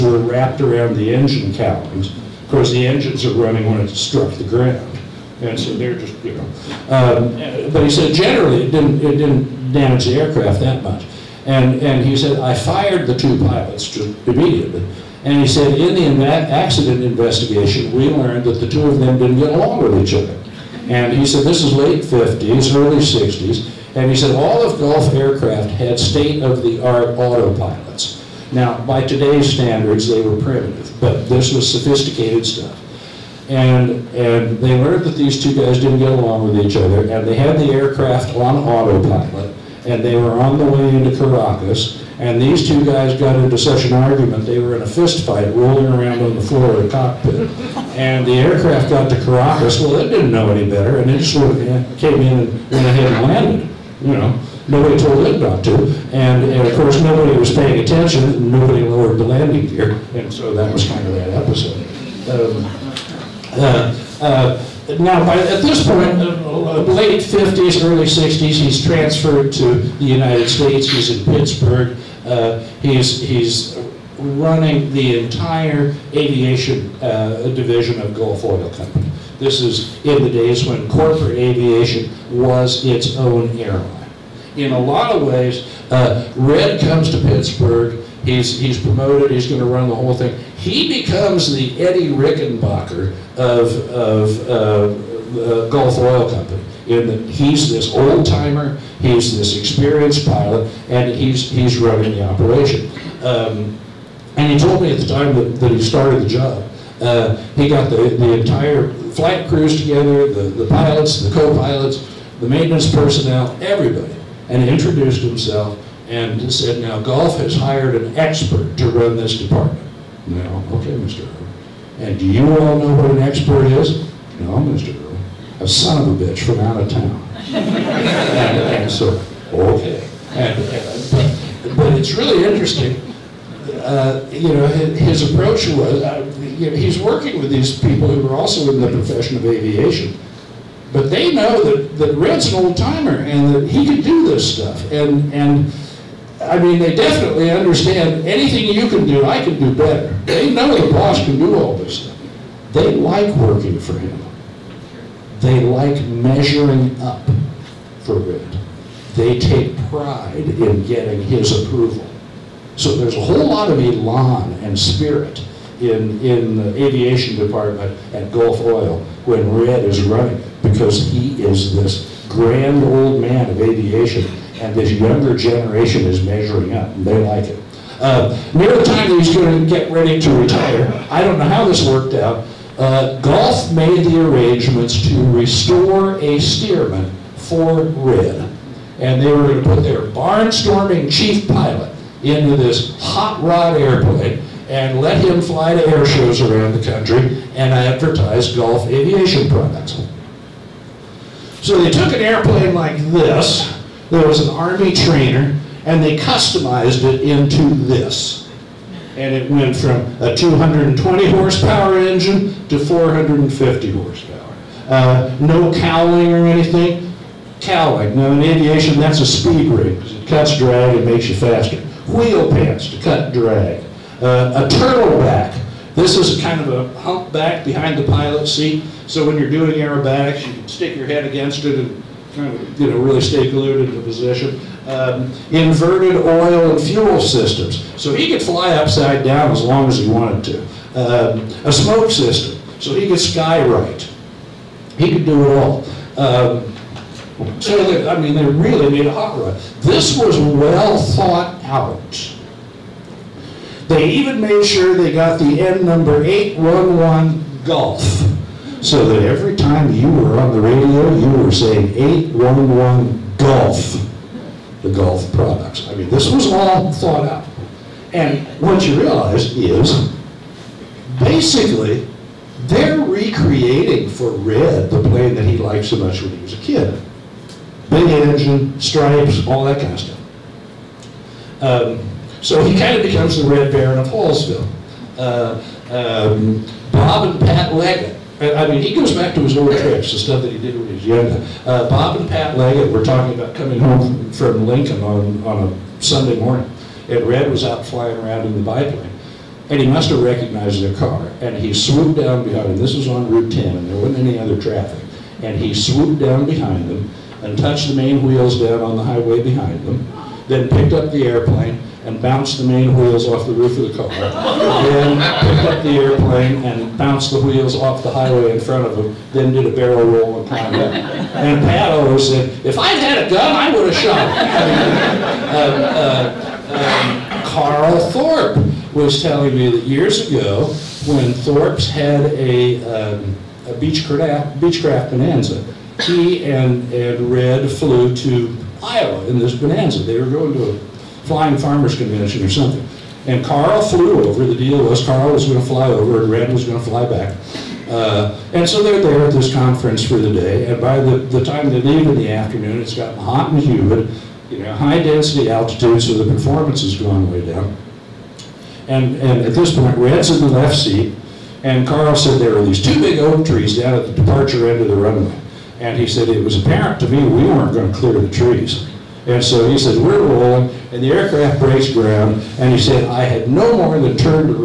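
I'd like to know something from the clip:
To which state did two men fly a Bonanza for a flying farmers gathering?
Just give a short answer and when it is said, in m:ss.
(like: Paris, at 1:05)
Iowa, at 5:38.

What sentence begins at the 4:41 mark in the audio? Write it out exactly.
Um, so he kind of becomes the Red Baron of Hallsville.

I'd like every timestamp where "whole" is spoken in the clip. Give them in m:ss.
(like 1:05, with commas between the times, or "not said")
1:29, 2:43.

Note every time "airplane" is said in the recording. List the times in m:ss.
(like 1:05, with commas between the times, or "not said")
3:13, 3:22, 5:11, 5:15.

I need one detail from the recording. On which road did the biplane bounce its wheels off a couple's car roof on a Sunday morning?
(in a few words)
Route 10.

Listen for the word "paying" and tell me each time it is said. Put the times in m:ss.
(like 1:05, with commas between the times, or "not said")
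0:57.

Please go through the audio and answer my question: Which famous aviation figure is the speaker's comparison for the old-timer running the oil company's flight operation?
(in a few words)
Eddie Rickenbacker.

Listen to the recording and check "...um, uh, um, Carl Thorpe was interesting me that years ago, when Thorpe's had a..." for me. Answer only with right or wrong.
wrong.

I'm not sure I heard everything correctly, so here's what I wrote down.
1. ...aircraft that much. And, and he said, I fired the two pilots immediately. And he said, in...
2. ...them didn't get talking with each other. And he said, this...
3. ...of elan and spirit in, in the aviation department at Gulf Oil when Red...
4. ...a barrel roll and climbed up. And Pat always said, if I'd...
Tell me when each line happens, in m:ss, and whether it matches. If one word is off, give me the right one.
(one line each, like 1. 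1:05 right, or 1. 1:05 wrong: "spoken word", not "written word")
1. 0:10 right
2. 0:18 wrong: "along", not "talking"
3. 2:43 right
4. 5:19 right.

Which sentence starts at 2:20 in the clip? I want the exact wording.
But they know that, that Red's an old timer and that he can do this stuff.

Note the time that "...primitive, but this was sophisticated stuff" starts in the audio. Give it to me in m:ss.
0:30.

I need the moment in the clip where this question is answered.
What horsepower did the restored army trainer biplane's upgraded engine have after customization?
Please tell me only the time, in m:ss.
3:32.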